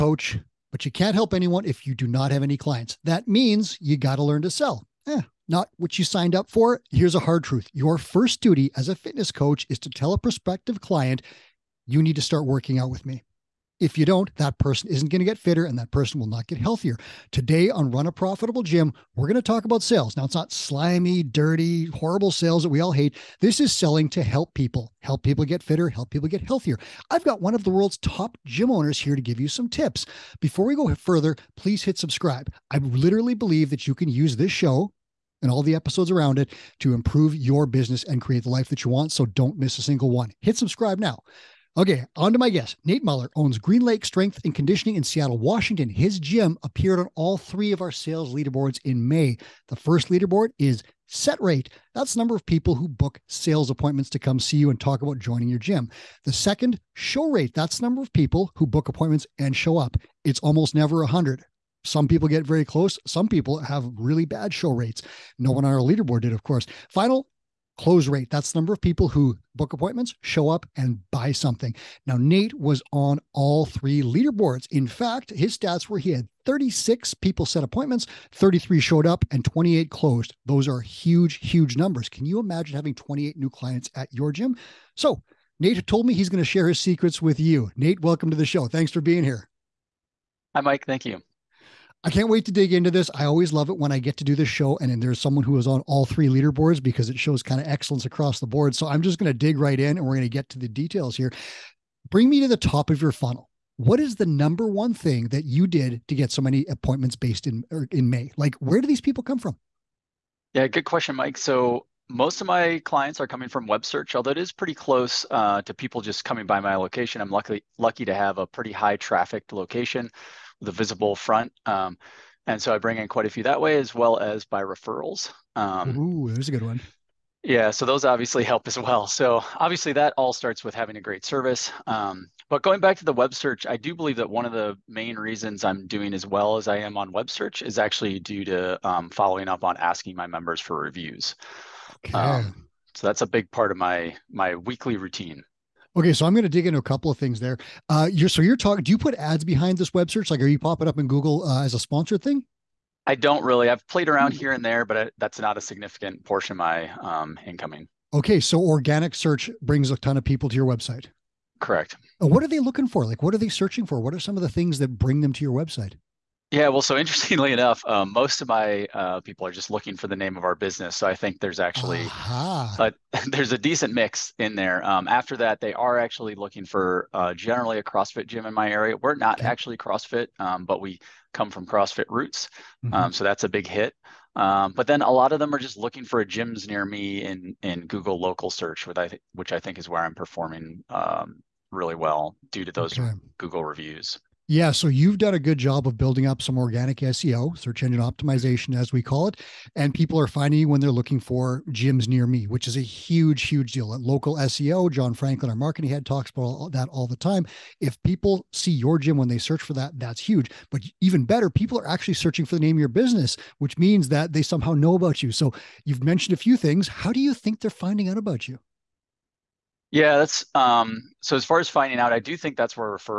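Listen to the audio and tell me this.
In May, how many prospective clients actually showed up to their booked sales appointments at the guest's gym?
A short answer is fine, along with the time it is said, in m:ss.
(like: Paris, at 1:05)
33, at 1:18.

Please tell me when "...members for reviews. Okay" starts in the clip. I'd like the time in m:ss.
2:20.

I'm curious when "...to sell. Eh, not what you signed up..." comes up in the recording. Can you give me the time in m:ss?
0:04.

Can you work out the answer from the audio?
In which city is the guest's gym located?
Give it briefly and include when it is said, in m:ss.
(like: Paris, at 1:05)
Seattle, at 0:45.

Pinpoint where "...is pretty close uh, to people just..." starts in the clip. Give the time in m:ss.
1:54.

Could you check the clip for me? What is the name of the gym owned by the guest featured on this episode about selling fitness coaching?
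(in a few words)
Green Lake Strength and Conditioning.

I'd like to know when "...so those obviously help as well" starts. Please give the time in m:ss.
2:07.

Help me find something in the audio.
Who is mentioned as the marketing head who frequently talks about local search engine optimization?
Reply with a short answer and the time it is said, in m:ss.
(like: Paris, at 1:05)
John Franklin, at 3:24.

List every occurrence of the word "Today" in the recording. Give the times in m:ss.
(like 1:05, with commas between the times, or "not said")
0:17.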